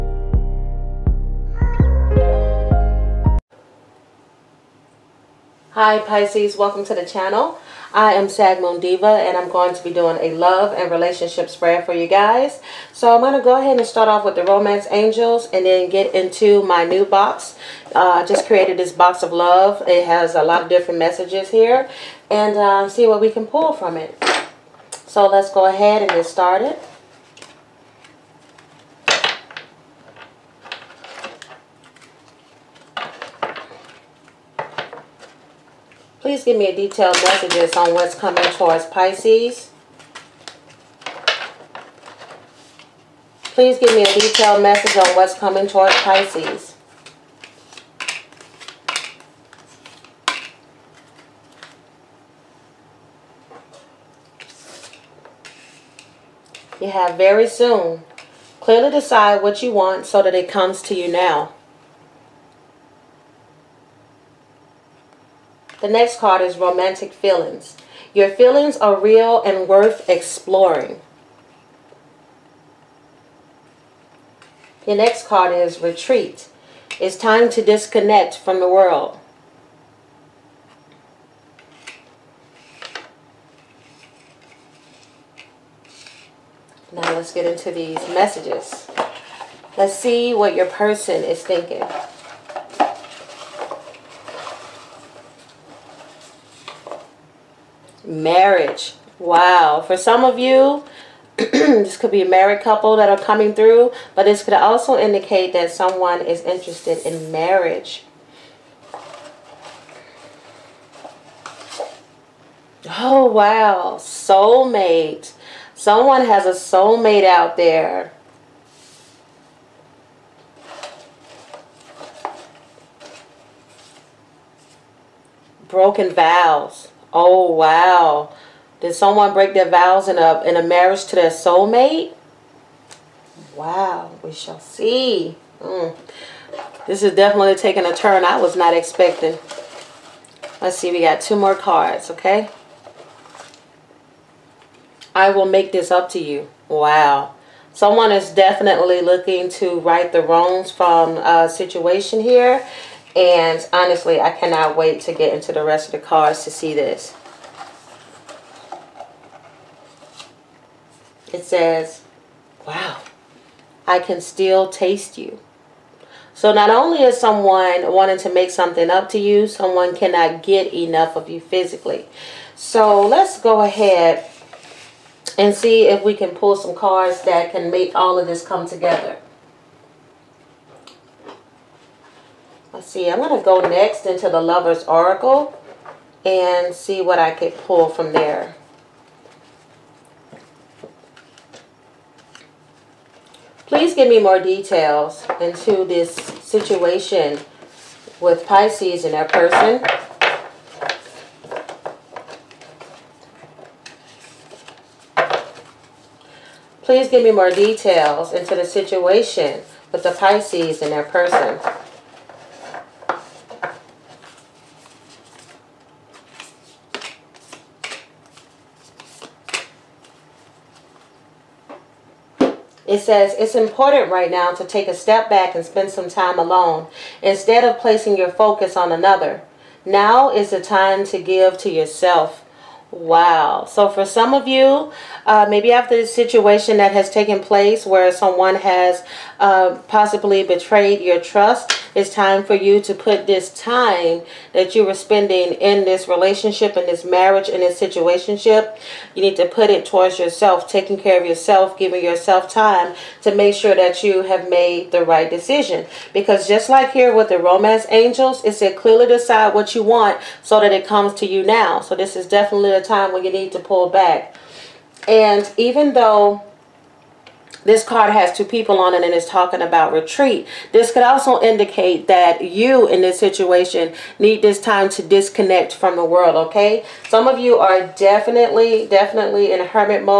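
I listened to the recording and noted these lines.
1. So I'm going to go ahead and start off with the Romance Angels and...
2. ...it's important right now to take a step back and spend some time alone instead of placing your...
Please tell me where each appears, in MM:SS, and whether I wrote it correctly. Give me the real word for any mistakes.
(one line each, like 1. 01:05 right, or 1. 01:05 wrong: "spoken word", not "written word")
1. 00:12 right
2. 03:43 right.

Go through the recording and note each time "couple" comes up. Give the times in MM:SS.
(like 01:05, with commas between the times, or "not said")
01:42.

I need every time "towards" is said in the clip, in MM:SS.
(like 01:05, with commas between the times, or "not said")
00:38, 00:45, 04:09.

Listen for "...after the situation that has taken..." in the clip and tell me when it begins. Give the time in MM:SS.
03:55.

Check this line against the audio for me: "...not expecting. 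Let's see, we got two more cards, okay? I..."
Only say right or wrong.
right.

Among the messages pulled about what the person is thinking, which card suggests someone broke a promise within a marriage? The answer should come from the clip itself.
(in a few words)
Broken vows.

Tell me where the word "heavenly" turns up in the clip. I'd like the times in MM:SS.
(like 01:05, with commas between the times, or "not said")
not said.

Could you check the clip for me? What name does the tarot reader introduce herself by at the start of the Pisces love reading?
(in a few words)
Sag Moon Diva.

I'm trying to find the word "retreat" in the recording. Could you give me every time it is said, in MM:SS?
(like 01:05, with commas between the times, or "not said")
01:15, 04:29.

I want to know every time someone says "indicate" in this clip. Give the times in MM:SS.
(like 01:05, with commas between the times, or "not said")
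01:44, 04:31.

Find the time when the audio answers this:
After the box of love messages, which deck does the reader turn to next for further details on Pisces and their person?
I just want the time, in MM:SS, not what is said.
03:04.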